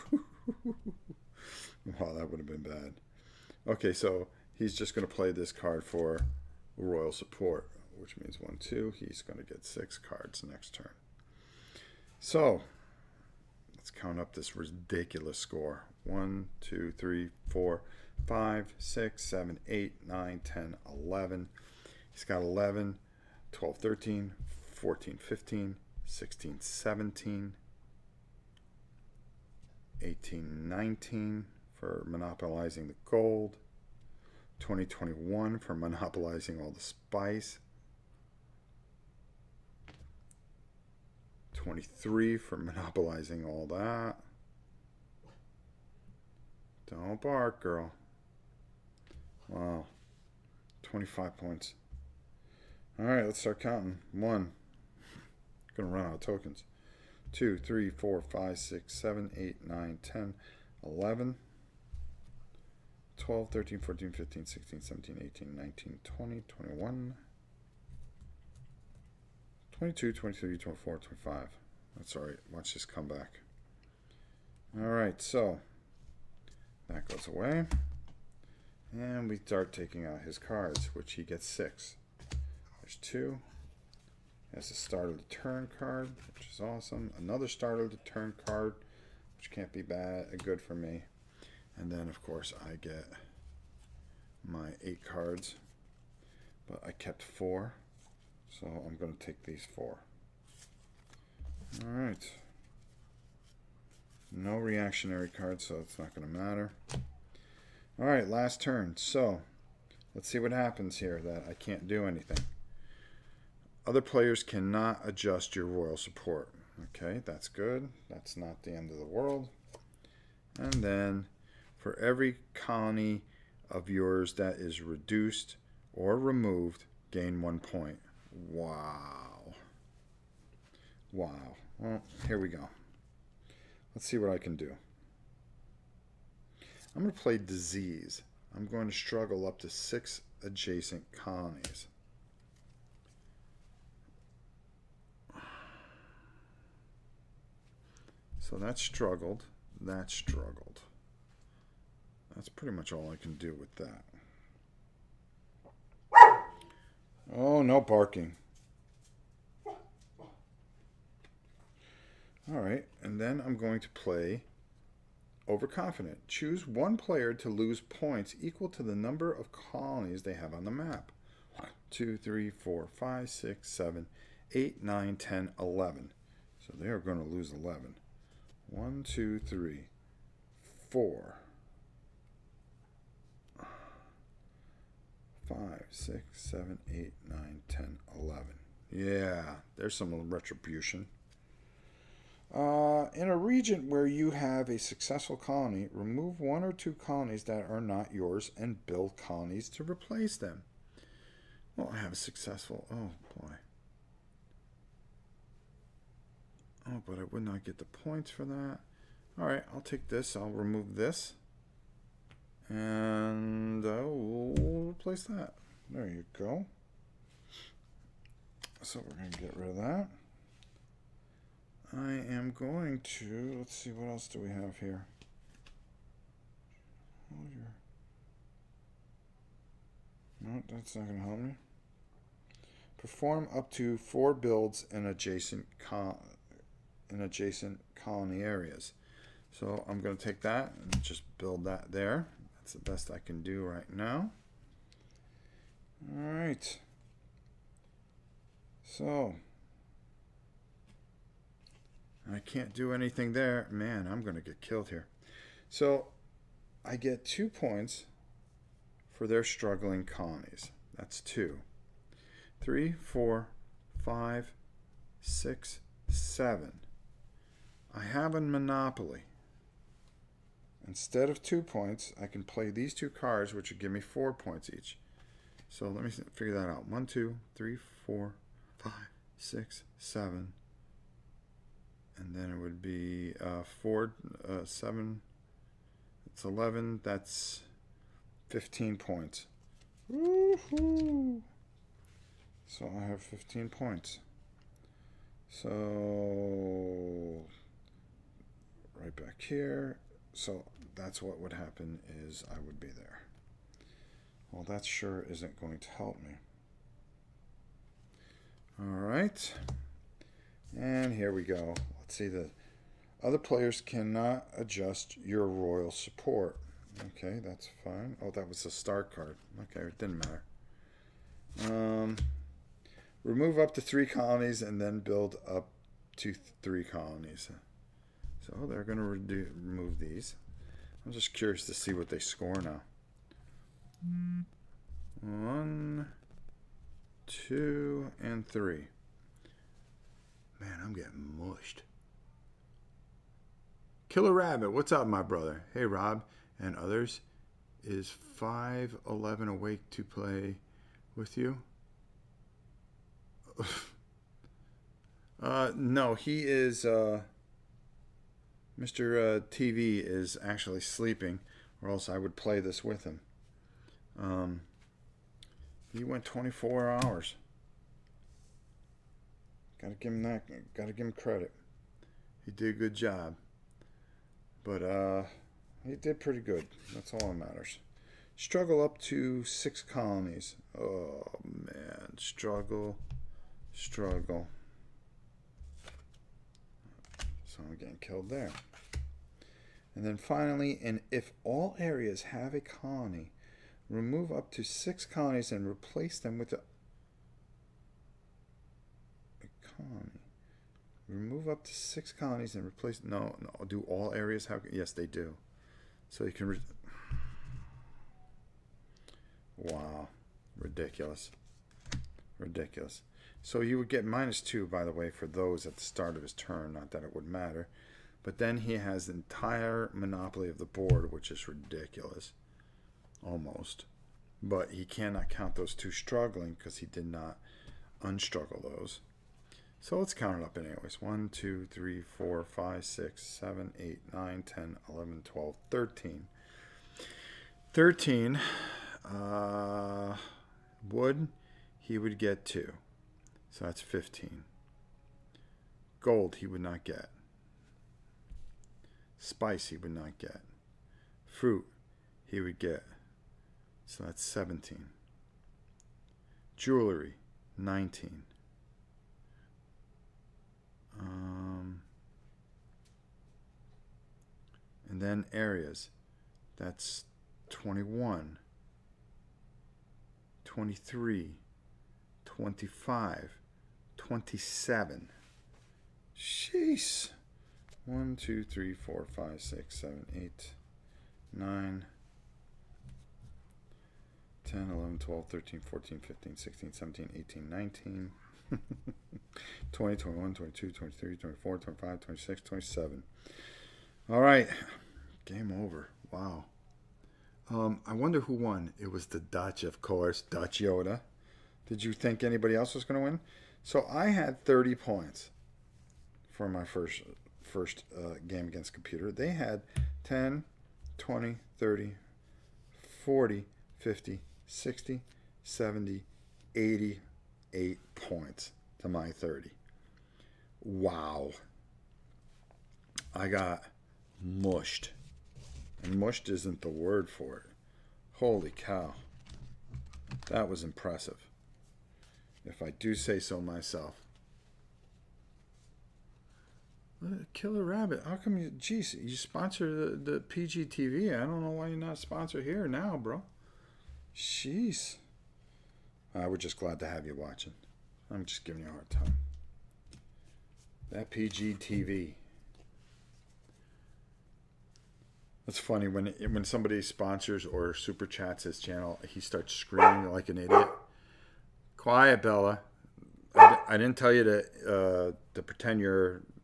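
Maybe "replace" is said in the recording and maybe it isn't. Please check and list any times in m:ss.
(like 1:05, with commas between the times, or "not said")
3:19, 3:34, 6:35, 6:42.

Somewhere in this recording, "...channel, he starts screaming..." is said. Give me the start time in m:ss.
9:18.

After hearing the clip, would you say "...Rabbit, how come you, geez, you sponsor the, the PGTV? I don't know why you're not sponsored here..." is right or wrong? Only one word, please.
right.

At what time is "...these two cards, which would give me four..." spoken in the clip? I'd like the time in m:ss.
4:32.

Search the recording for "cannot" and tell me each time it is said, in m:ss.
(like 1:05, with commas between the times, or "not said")
1:54, 5:13, 7:04.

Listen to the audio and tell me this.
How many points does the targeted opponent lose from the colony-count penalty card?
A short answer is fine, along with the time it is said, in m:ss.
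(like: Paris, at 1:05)
11, at 2:57.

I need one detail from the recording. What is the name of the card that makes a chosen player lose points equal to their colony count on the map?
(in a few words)
Overconfident.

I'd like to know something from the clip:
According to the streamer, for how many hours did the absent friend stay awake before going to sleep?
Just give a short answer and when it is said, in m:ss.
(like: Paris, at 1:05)
24 hours, at 6:06.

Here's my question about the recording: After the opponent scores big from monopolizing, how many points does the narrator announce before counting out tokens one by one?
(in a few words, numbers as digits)
25.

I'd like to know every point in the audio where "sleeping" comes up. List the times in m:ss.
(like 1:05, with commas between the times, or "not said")
6:00.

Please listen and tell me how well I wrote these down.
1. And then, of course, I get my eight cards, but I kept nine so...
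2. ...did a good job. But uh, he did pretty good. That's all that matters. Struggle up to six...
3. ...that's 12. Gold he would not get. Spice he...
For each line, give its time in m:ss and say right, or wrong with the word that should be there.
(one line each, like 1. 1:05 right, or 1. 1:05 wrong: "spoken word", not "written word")
1. 1:31 wrong: "four", not "nine"
2. 6:12 right
3. 7:23 wrong: "15", not "12".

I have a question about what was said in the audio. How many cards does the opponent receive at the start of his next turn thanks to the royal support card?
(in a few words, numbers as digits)
6.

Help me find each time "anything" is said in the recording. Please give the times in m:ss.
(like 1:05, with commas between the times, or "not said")
1:52, 4:12.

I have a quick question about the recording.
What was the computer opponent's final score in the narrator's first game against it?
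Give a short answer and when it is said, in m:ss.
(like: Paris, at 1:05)
88, at 8:36.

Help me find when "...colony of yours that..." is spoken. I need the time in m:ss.
2:02.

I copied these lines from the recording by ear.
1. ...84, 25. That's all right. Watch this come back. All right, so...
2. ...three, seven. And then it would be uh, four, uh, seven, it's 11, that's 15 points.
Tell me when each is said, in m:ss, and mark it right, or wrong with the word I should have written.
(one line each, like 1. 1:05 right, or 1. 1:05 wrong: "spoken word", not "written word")
1. 1:10 wrong: "24", not "84"
2. 4:39 wrong: "six", not "three".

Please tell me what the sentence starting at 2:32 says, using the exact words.
That's pretty much all I can do with that.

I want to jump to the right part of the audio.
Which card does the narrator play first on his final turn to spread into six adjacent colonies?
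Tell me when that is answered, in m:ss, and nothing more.
2:17.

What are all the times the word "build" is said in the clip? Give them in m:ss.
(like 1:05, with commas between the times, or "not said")
3:18, 3:54, 4:01, 5:24.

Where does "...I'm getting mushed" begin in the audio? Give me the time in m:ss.
5:40.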